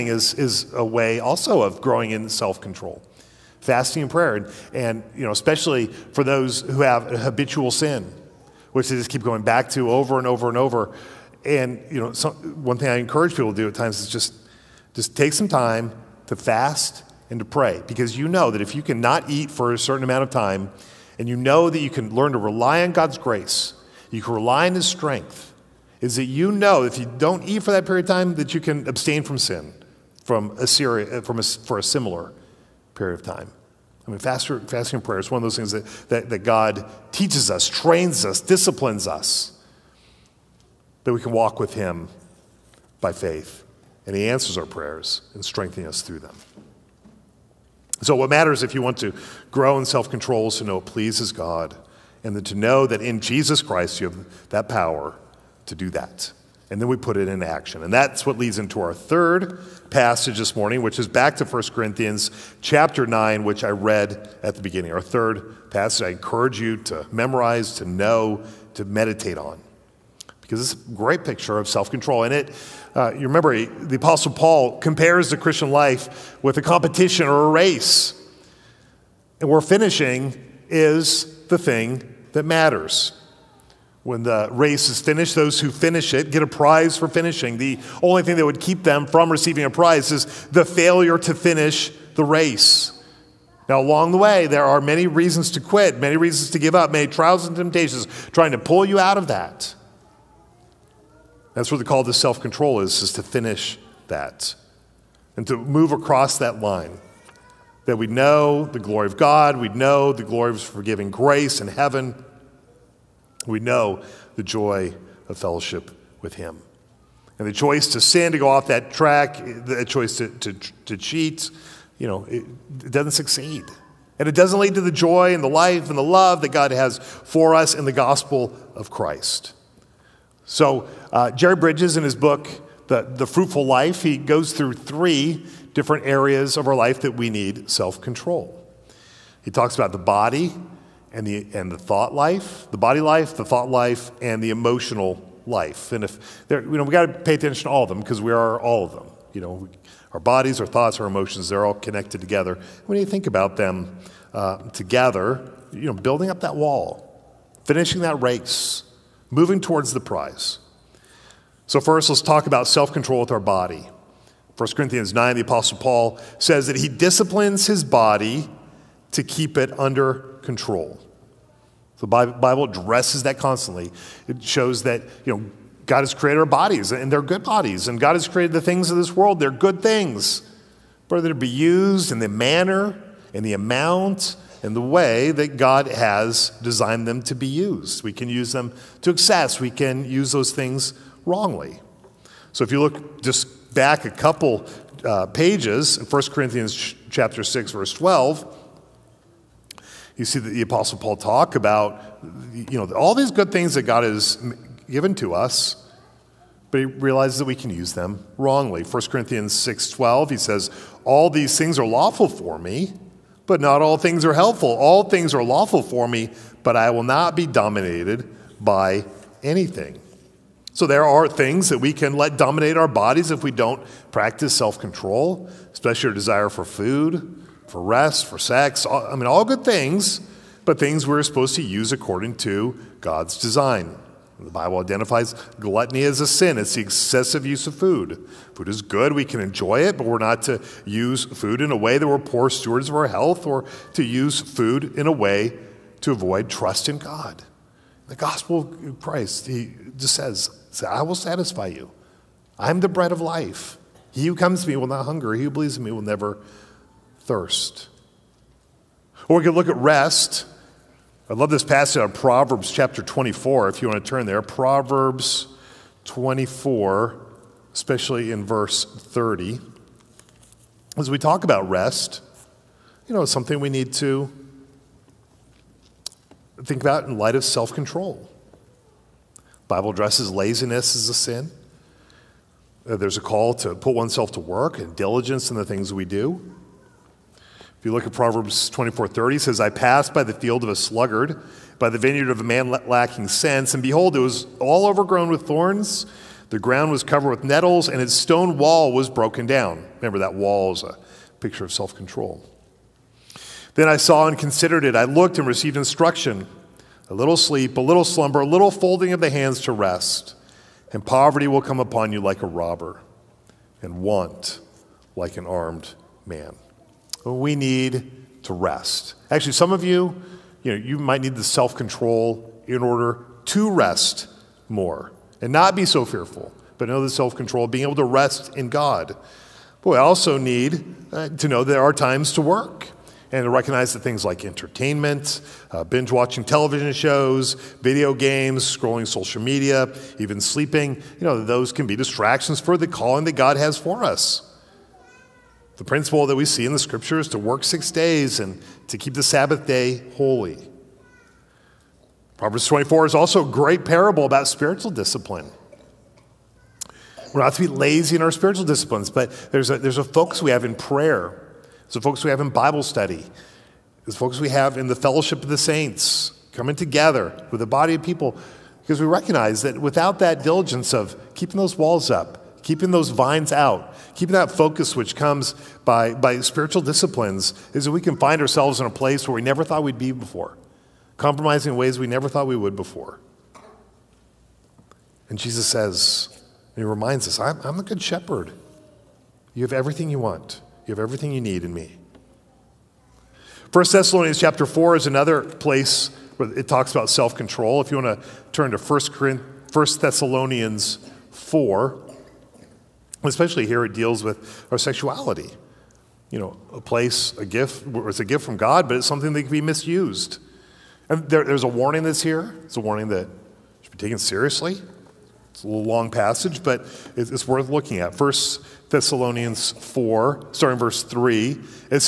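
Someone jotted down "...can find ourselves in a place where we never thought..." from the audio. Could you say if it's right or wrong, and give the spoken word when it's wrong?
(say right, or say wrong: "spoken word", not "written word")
right.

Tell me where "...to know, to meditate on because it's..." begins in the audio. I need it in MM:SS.
01:07.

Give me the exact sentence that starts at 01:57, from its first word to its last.
And the choice to sin, to go off that track, the choice to, to, to cheat, you know, it, it doesn't succeed.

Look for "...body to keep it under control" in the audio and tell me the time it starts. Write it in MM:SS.
02:47.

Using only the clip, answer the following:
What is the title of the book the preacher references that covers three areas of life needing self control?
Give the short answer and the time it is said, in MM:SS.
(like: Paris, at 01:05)
The Fruitful Life, at 02:13.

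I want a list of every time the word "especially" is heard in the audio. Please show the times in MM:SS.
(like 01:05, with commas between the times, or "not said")
00:05, 03:45, 04:27, 06:43.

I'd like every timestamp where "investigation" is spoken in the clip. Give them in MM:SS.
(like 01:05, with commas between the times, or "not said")
not said.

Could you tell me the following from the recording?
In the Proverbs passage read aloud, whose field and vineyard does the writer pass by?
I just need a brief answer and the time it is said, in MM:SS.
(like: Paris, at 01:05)
A sluggard's, at 04:50.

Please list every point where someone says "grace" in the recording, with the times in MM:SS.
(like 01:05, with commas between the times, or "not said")
00:23, 01:51.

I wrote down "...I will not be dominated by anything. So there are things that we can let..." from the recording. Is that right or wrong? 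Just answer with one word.
right.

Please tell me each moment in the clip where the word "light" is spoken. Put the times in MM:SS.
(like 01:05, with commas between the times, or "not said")
04:37.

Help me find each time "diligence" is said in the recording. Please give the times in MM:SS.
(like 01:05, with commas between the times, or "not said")
04:44, 06:10.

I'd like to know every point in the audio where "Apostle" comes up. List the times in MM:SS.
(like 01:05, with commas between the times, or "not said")
01:13, 02:45, 03:20.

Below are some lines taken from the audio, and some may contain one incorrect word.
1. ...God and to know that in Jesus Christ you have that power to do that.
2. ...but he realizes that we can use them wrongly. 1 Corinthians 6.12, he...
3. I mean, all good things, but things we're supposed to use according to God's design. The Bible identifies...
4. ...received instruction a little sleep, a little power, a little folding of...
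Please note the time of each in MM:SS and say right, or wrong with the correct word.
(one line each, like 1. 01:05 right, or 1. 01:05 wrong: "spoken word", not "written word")
1. 00:51 right
2. 03:26 right
3. 03:48 right
4. 05:05 wrong: "slumber", not "power".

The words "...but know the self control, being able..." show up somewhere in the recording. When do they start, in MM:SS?
05:26.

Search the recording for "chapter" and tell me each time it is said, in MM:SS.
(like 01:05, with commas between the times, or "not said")
01:02, 03:17, 04:22, 06:34.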